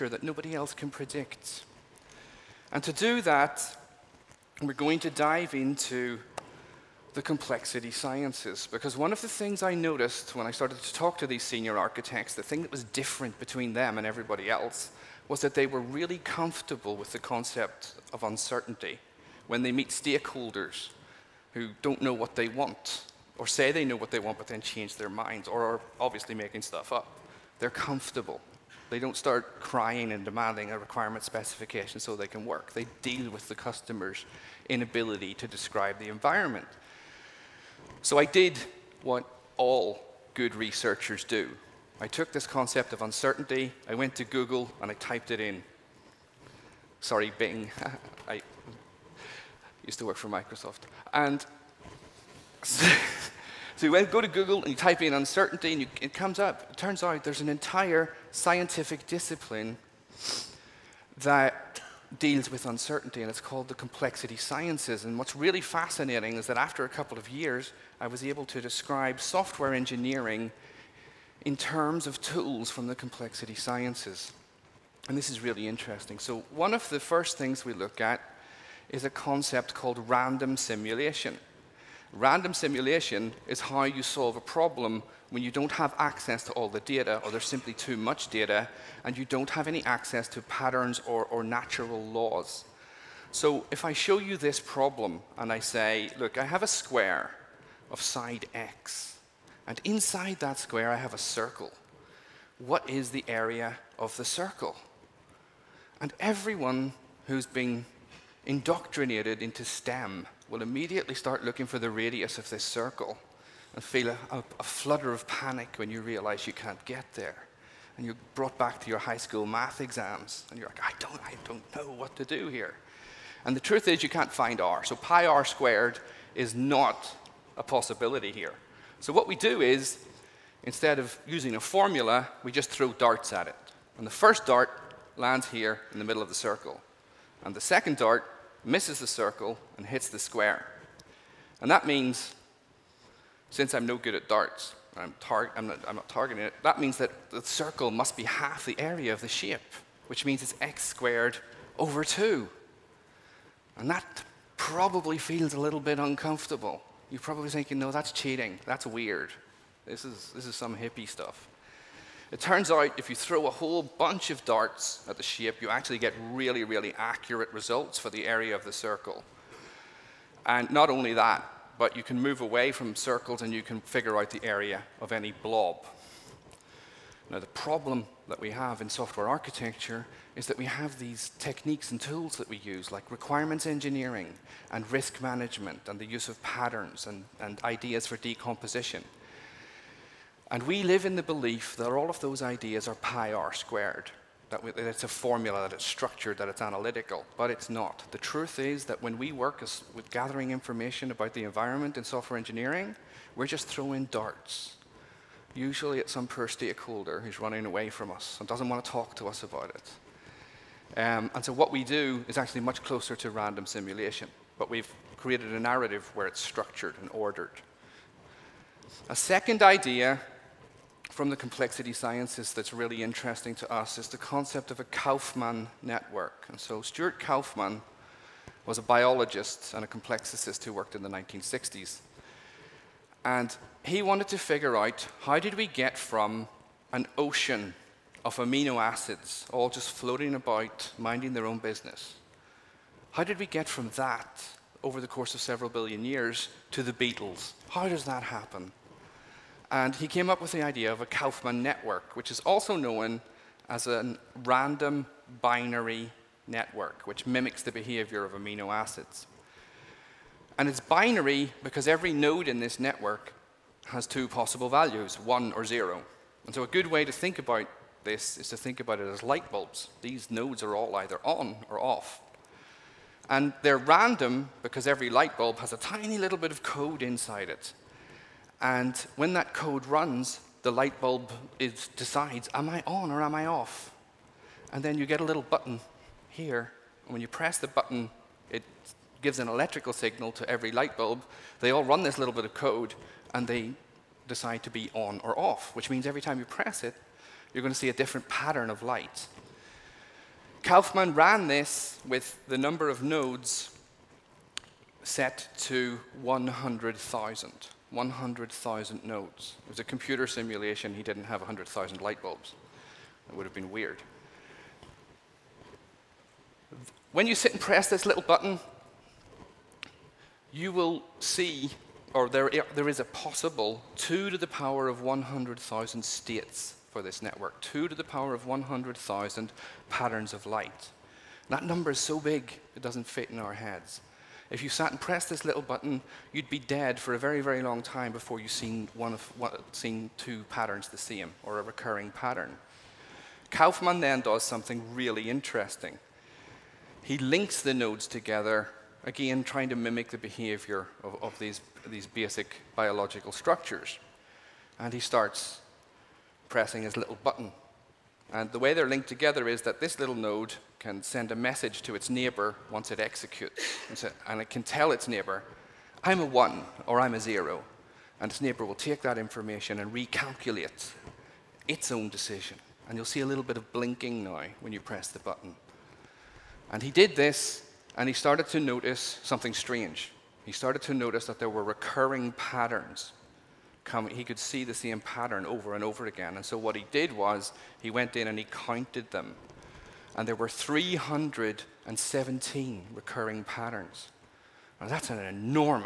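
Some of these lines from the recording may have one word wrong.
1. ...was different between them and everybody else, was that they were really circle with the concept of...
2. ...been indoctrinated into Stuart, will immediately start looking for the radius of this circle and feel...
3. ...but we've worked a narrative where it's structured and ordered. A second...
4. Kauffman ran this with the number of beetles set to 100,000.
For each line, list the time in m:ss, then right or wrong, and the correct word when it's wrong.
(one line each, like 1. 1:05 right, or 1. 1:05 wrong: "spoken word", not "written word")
1. 0:12 wrong: "comfortable", not "circle"
2. 1:47 wrong: "STEM", not "Stuart"
3. 3:34 wrong: "created", not "worked"
4. 5:00 wrong: "nodes", not "beetles".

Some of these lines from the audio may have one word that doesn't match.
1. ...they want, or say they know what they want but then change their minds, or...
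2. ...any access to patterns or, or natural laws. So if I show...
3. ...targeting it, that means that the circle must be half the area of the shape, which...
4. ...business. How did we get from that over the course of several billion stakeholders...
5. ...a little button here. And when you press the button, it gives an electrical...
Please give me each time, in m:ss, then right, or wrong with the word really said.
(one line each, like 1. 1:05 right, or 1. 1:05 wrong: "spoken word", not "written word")
1. 0:22 right
2. 1:29 right
3. 2:26 right
4. 4:01 wrong: "years", not "stakeholders"
5. 4:45 right.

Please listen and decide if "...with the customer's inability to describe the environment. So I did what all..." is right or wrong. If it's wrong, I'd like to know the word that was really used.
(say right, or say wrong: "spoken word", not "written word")
right.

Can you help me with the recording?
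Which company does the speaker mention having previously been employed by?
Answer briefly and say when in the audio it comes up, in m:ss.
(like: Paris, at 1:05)
Microsoft, at 0:50.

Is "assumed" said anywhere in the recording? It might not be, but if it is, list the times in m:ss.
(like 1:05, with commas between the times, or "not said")
not said.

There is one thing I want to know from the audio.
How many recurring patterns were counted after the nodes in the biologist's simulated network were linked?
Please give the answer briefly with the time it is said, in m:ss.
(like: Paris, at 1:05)
317, at 6:30.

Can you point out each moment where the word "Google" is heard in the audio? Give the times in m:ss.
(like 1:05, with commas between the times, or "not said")
0:44, 0:54.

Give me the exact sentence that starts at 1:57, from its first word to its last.
And you're brought back to your high school math exams, and you're like, I don't, I don't know what to do here.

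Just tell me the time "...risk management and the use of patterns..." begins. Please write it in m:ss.
3:04.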